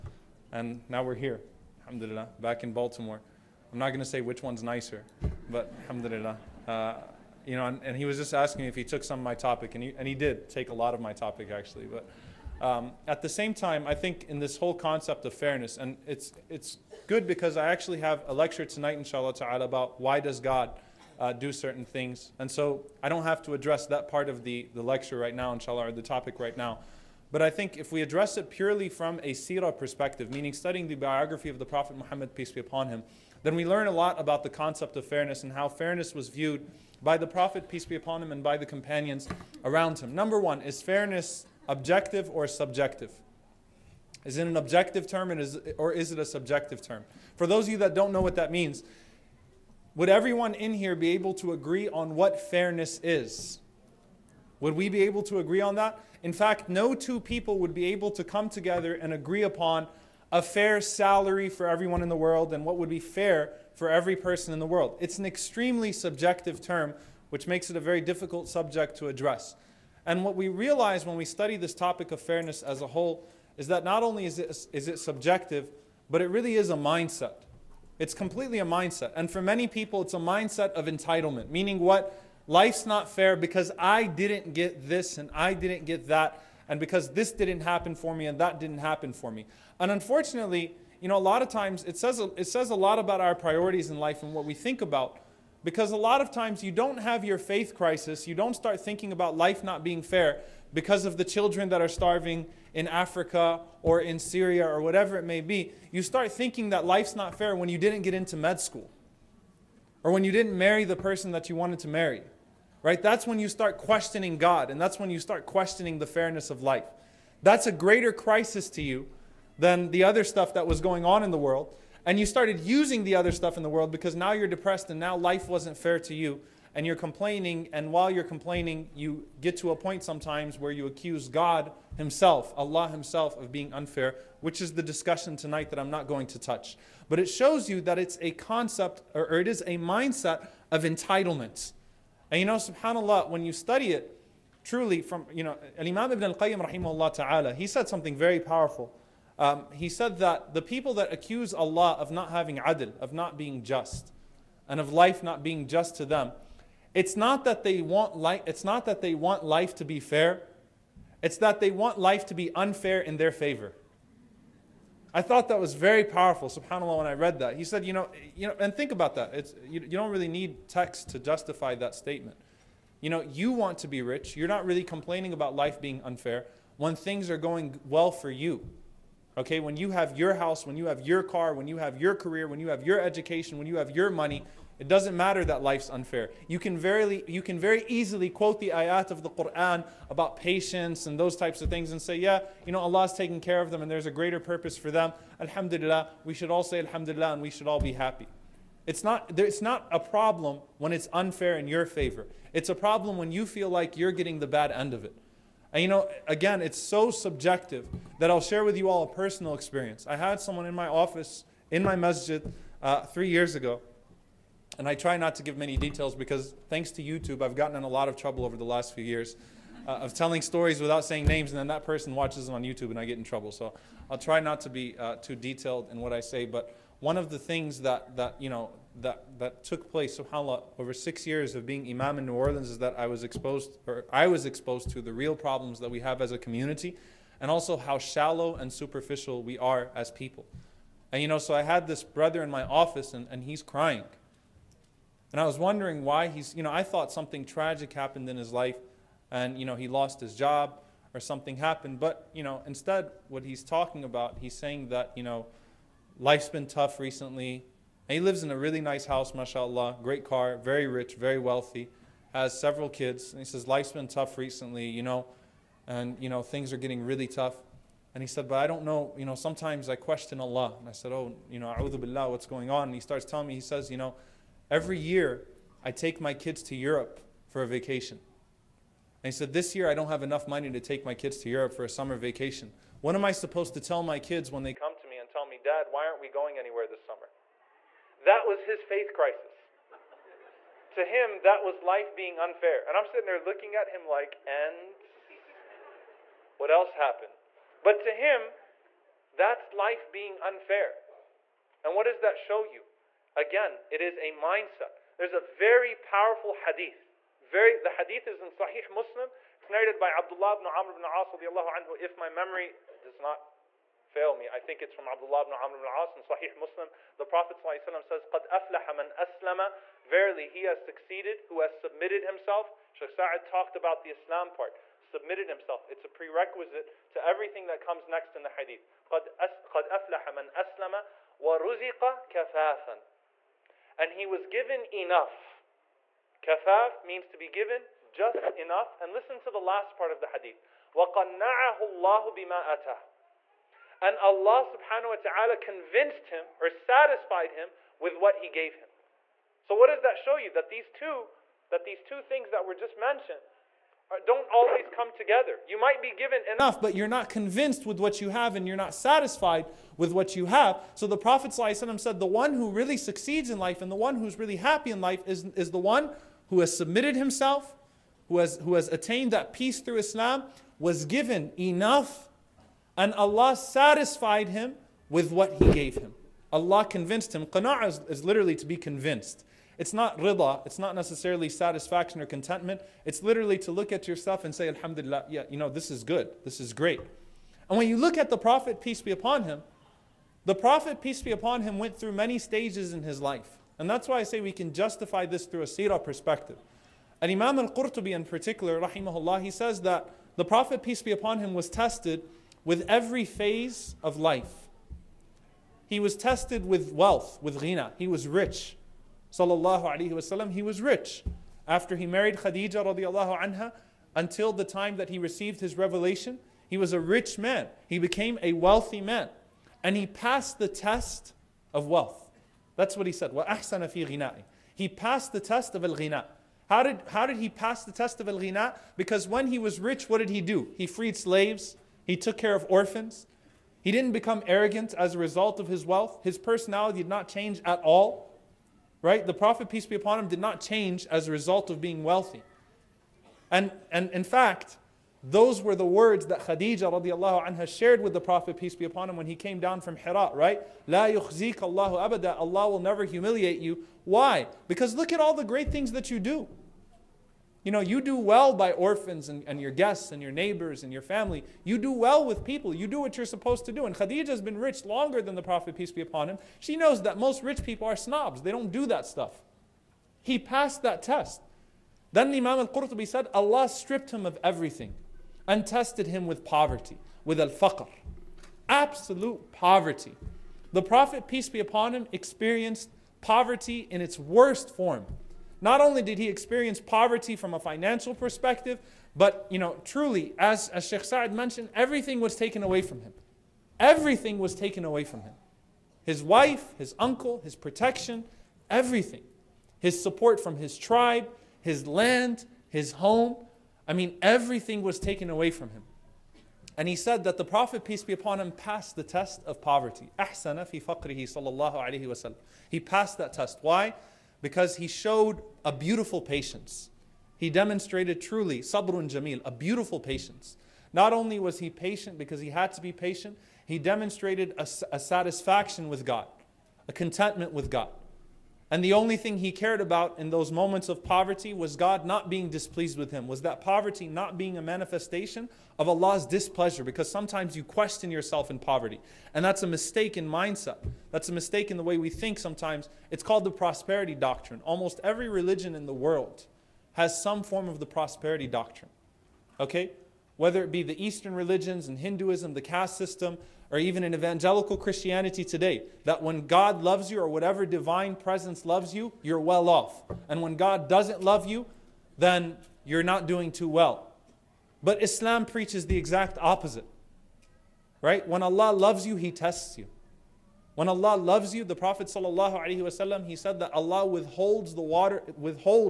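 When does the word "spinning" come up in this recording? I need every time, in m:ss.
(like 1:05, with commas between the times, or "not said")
not said.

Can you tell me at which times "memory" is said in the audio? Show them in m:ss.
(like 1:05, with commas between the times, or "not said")
5:12.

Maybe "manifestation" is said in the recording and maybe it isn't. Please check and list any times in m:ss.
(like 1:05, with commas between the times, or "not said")
8:54.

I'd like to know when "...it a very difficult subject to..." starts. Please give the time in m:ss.
1:07.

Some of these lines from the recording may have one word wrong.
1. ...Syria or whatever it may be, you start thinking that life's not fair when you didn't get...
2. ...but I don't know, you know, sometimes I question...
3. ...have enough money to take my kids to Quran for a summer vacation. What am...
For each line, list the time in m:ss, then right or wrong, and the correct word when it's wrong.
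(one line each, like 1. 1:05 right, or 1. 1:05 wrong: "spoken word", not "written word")
1. 1:44 right
2. 4:28 right
3. 4:40 wrong: "Europe", not "Quran".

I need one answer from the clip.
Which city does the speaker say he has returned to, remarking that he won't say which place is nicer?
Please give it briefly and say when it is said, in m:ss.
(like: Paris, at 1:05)
Baltimore, at 0:02.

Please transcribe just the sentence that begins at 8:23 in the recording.
I mean, everything was taken away from him.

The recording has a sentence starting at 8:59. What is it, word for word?
And that's a mistake in mindset.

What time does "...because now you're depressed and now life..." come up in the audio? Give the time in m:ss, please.
2:03.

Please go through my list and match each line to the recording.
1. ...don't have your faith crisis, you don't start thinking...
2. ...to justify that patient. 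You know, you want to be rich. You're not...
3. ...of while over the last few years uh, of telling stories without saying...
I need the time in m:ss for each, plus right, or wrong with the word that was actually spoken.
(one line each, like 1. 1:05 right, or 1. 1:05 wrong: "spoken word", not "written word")
1. 1:36 right
2. 2:51 wrong: "statement", not "patient"
3. 3:38 wrong: "trouble", not "while".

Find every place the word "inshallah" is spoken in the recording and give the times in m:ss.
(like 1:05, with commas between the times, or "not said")
0:18, 0:25.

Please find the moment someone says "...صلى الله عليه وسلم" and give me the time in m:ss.
8:31.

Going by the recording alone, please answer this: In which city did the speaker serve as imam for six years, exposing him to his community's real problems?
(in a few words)
New Orleans.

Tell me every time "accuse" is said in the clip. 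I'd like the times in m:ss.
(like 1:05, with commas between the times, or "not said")
2:10, 2:31.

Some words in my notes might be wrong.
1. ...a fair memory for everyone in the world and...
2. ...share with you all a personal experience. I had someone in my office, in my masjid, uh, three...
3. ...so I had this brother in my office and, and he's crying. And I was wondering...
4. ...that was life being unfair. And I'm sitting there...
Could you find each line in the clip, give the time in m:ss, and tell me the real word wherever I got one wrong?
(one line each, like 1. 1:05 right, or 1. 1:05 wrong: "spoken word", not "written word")
1. 1:00 wrong: "salary", not "memory"
2. 3:28 right
3. 4:01 right
4. 4:51 right.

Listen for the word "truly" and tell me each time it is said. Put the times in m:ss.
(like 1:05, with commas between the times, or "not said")
2:24, 8:09, 8:38.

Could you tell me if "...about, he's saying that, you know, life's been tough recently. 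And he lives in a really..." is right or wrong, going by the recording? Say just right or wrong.
right.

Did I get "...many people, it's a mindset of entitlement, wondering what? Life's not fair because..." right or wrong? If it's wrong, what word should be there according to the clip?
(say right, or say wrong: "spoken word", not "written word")
wrong: "meaning", not "wondering".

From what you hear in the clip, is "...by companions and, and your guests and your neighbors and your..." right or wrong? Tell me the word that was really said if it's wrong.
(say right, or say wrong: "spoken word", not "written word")
wrong: "orphans", not "companions".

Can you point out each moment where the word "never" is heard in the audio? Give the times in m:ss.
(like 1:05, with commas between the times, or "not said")
7:32.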